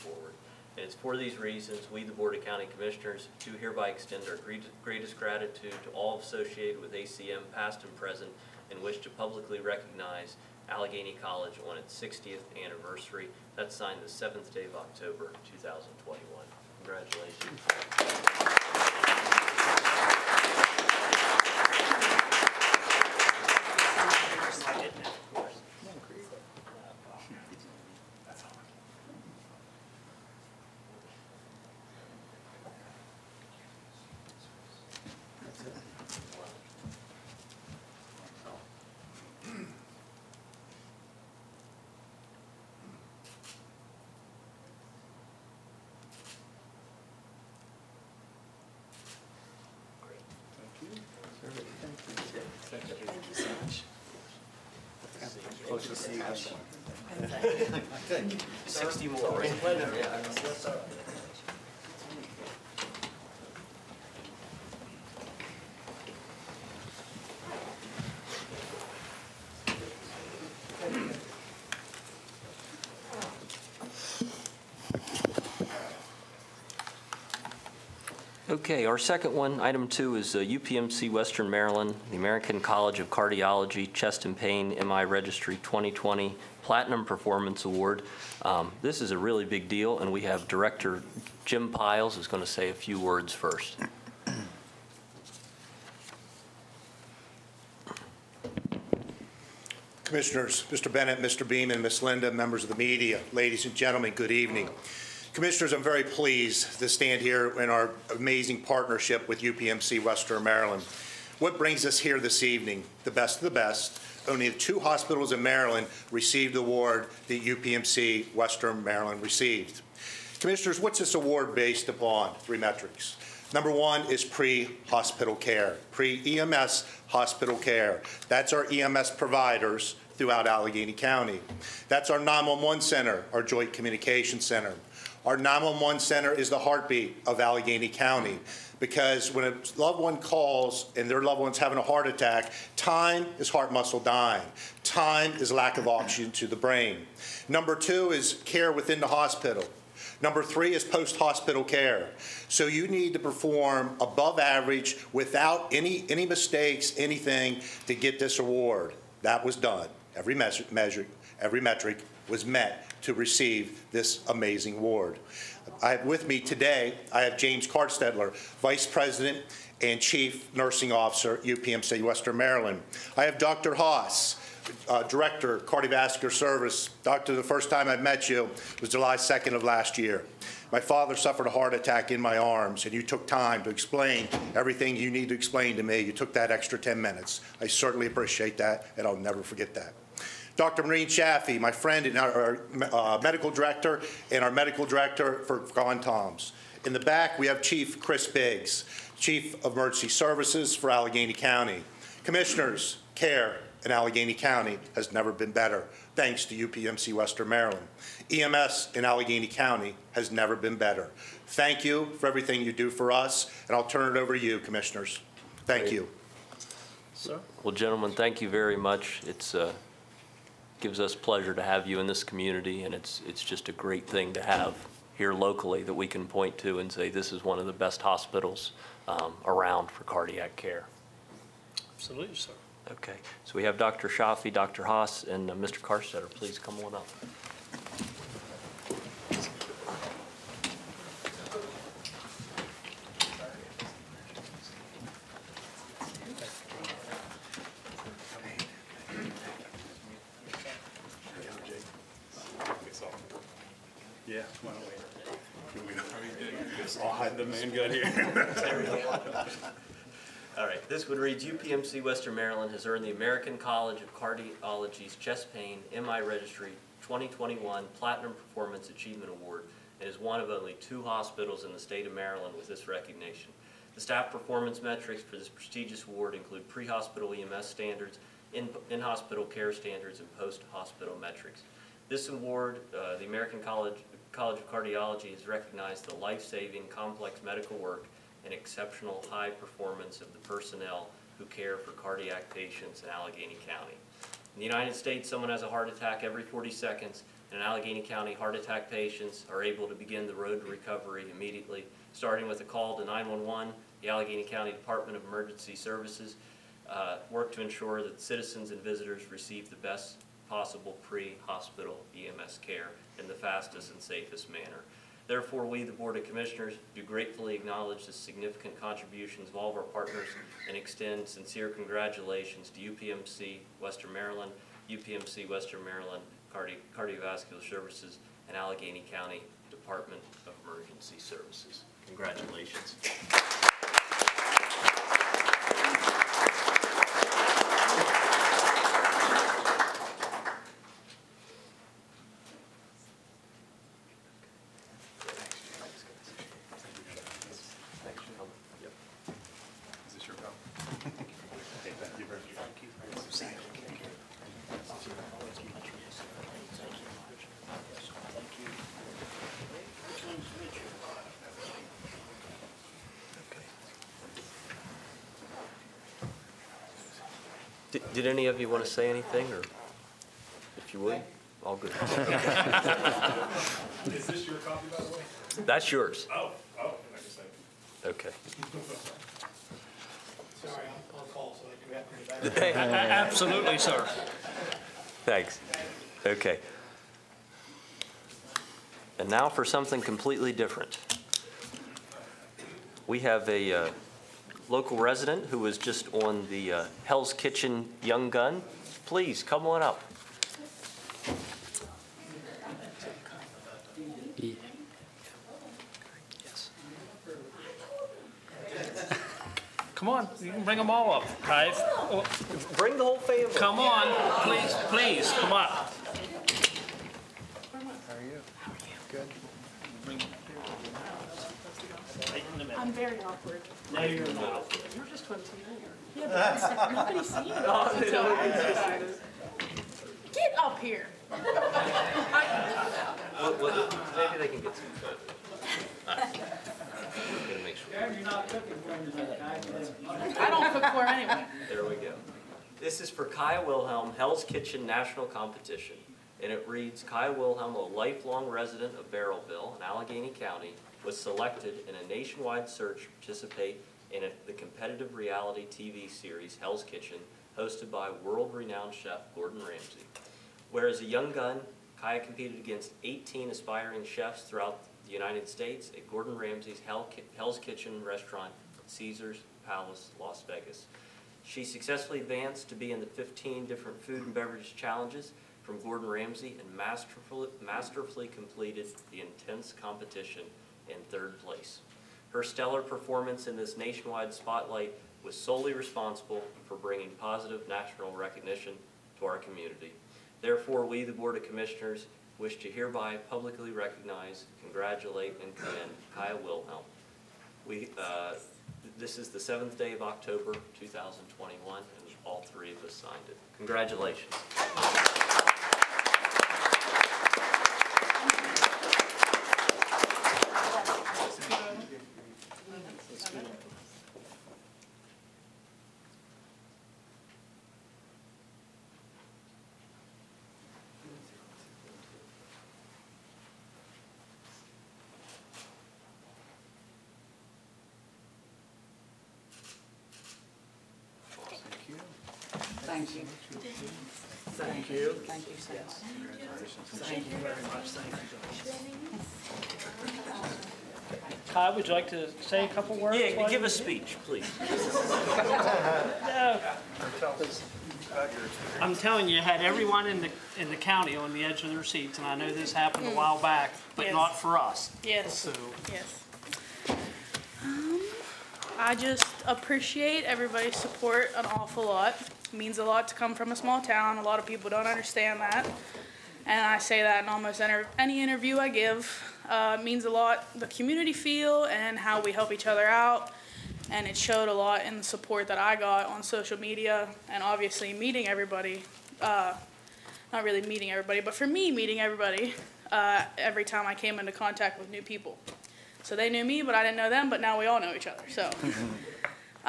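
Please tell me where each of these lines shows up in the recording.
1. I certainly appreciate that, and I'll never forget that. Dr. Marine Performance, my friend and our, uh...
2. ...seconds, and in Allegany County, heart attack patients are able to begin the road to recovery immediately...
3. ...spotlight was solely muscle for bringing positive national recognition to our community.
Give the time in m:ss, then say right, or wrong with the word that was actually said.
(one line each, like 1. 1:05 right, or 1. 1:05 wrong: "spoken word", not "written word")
1. 3:07 wrong: "Chaffee", not "Performance"
2. 4:56 right
3. 8:04 wrong: "responsible", not "muscle".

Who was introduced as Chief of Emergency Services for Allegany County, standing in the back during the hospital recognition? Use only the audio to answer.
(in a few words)
Chris Biggs.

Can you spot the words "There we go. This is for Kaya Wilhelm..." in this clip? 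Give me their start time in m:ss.
7:21.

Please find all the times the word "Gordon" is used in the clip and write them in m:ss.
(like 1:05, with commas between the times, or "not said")
7:39, 7:46, 7:55.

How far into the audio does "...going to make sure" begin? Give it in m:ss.
7:16.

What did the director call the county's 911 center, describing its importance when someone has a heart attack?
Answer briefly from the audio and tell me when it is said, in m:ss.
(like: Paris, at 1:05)
the heartbeat of Allegany County, at 2:16.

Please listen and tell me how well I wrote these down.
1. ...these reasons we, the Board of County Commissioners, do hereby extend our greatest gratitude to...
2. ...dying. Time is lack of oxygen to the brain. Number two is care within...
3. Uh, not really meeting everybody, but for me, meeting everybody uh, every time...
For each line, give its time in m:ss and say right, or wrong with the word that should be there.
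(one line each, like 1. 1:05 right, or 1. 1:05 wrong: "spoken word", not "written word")
1. 0:01 right
2. 2:24 right
3. 9:39 right.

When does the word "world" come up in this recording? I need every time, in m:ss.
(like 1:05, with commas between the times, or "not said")
7:38.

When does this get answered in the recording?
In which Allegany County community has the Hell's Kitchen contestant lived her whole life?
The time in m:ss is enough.
7:29.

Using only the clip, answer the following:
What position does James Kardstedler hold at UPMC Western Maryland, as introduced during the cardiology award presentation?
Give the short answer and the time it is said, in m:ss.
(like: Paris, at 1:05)
Vice President and Chief Nursing Officer, at 2:48.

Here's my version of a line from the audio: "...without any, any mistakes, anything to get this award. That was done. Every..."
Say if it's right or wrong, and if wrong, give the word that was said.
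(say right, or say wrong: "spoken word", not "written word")
right.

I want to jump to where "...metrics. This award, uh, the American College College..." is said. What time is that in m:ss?
4:41.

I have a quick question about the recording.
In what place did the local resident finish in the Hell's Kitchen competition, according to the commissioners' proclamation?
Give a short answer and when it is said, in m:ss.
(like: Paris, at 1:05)
third place, at 8:01.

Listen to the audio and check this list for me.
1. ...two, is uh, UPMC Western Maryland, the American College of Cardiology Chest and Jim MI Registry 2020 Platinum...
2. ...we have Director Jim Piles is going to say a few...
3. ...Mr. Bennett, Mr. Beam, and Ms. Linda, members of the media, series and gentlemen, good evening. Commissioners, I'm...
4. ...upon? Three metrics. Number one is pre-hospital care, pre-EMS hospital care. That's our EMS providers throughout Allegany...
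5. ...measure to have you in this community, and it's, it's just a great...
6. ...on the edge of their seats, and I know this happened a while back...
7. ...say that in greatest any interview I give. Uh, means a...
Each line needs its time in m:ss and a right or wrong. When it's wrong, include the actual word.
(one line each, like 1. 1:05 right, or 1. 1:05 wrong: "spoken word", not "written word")
1. 1:19 wrong: "Pain", not "Jim"
2. 1:30 right
3. 1:40 wrong: "ladies", not "series"
4. 2:01 right
5. 3:41 wrong: "pleasure", not "measure"
6. 9:11 right
7. 9:26 wrong: "almost", not "greatest".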